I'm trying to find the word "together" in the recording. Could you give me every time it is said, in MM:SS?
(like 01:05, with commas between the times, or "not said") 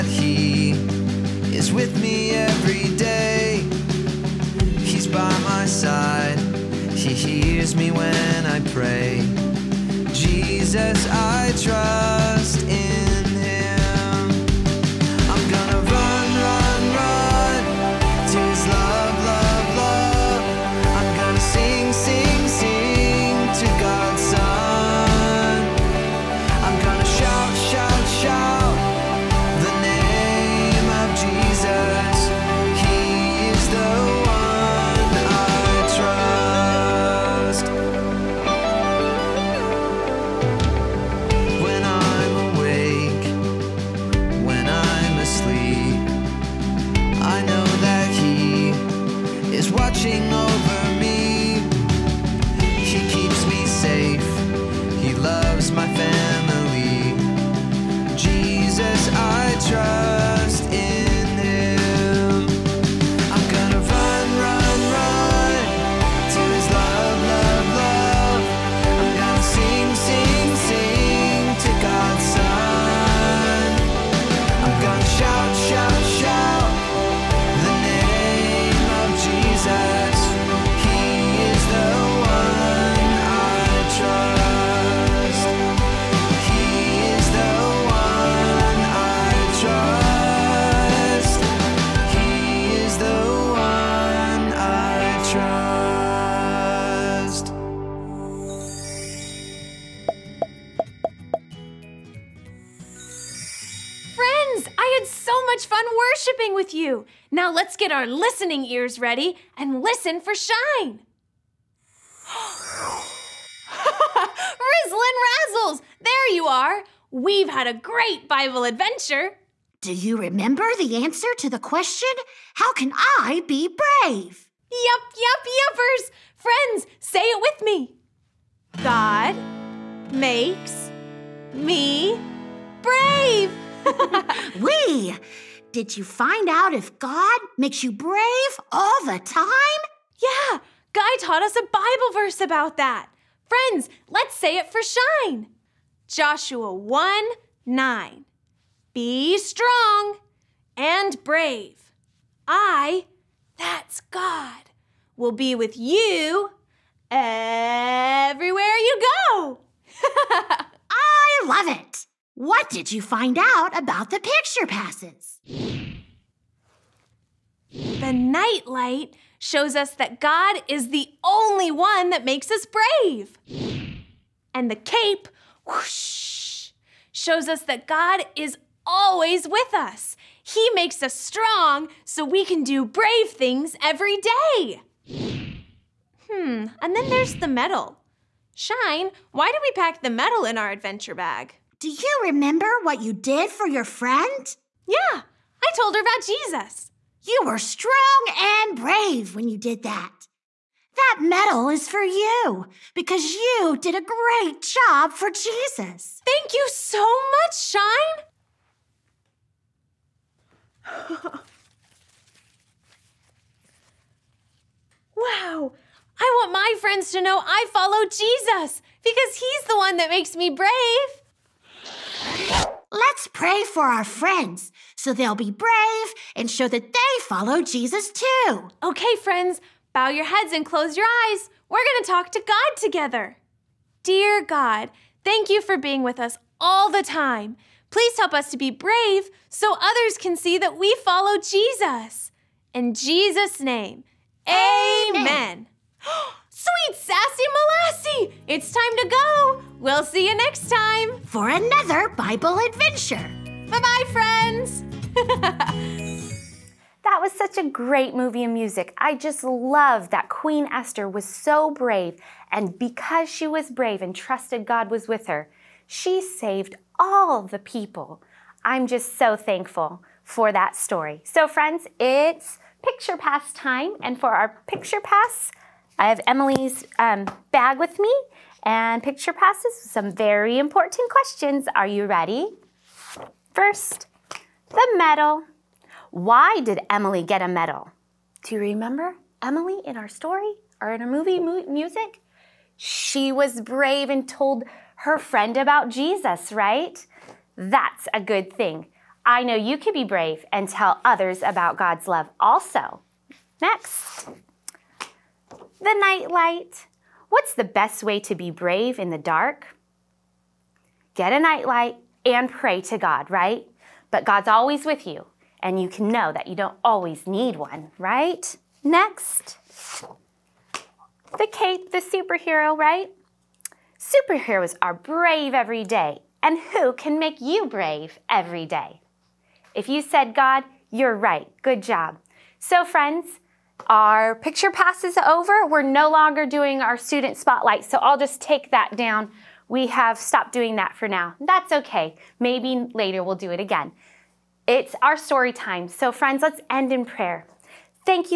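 03:52.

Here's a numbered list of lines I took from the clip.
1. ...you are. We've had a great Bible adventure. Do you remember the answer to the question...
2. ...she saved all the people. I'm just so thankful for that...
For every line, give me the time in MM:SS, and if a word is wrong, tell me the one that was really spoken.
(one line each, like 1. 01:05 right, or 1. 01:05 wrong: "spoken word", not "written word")
1. 01:56 right
2. 04:25 right.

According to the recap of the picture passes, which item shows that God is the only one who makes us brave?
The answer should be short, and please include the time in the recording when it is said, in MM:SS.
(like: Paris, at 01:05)
night light, at 02:48.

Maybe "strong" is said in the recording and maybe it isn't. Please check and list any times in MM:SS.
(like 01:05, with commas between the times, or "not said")
02:29, 03:01, 03:17.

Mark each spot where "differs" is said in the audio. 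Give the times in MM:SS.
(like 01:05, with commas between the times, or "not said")
not said.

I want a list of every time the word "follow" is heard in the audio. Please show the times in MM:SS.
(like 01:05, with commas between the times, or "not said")
03:37, 03:47, 04:01.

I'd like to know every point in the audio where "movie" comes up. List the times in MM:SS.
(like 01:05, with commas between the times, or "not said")
04:18, 04:51.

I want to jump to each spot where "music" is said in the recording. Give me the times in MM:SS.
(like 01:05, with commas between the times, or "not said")
04:18, 04:51.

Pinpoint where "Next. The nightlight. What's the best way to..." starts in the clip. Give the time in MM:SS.
05:03.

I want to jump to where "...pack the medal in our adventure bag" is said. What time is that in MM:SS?
03:09.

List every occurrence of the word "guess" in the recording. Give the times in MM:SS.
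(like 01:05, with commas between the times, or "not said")
not said.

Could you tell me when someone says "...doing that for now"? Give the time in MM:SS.
05:40.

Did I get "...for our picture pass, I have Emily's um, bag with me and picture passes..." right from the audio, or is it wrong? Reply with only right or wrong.
right.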